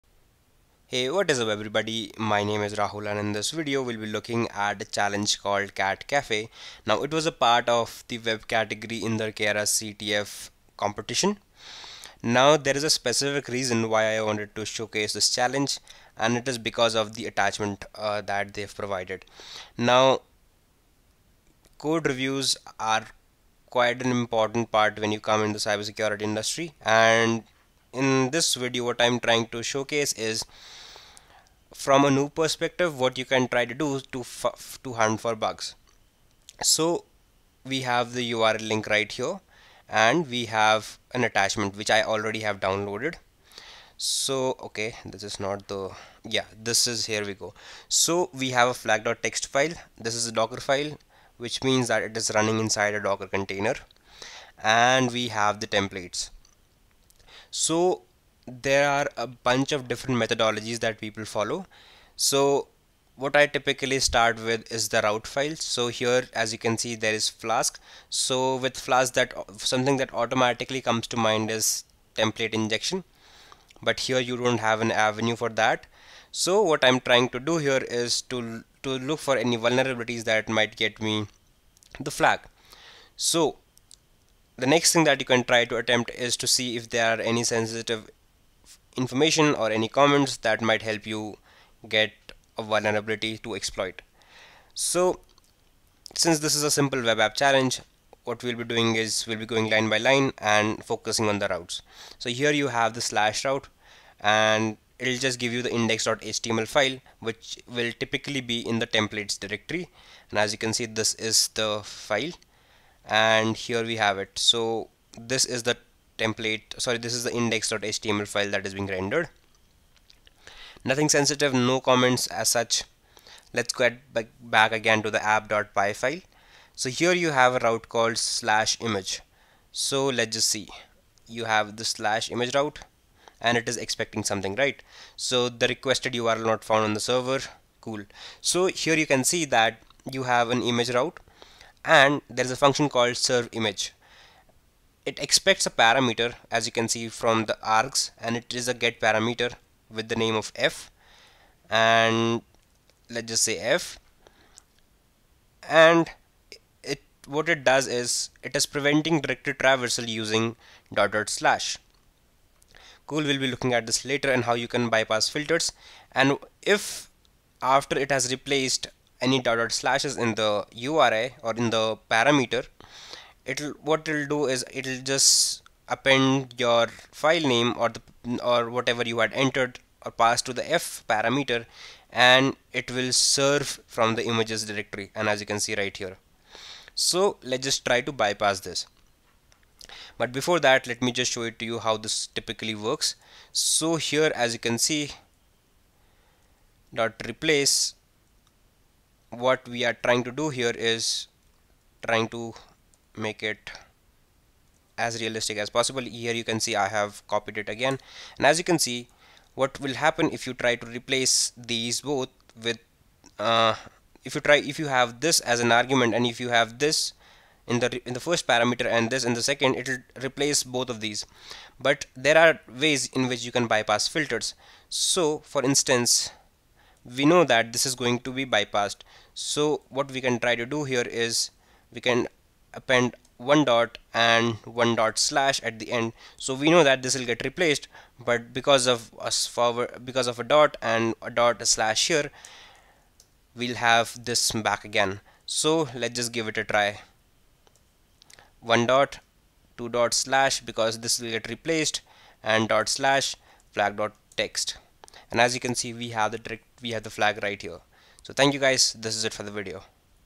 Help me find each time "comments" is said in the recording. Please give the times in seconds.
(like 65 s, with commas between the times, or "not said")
89 s, 121 s.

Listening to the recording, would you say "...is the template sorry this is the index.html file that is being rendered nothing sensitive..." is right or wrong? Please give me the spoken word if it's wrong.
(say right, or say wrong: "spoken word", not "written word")
right.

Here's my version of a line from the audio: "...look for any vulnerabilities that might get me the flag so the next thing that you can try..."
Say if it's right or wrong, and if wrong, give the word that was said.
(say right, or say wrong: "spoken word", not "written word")
right.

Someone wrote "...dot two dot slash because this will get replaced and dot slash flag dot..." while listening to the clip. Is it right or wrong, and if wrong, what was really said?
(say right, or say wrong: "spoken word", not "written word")
right.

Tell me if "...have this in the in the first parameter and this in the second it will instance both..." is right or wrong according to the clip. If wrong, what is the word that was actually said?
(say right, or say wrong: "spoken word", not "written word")
wrong: "replace", not "instance".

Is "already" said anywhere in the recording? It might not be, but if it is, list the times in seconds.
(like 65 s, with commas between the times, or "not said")
42 s.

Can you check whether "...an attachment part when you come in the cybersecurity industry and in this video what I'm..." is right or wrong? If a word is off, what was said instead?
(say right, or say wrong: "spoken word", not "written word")
wrong: "important", not "attachment".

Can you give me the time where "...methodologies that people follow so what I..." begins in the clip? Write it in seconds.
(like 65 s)
60 s.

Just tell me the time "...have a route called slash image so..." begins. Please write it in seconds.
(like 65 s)
127 s.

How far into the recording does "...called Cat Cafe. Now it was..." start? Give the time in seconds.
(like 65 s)
5 s.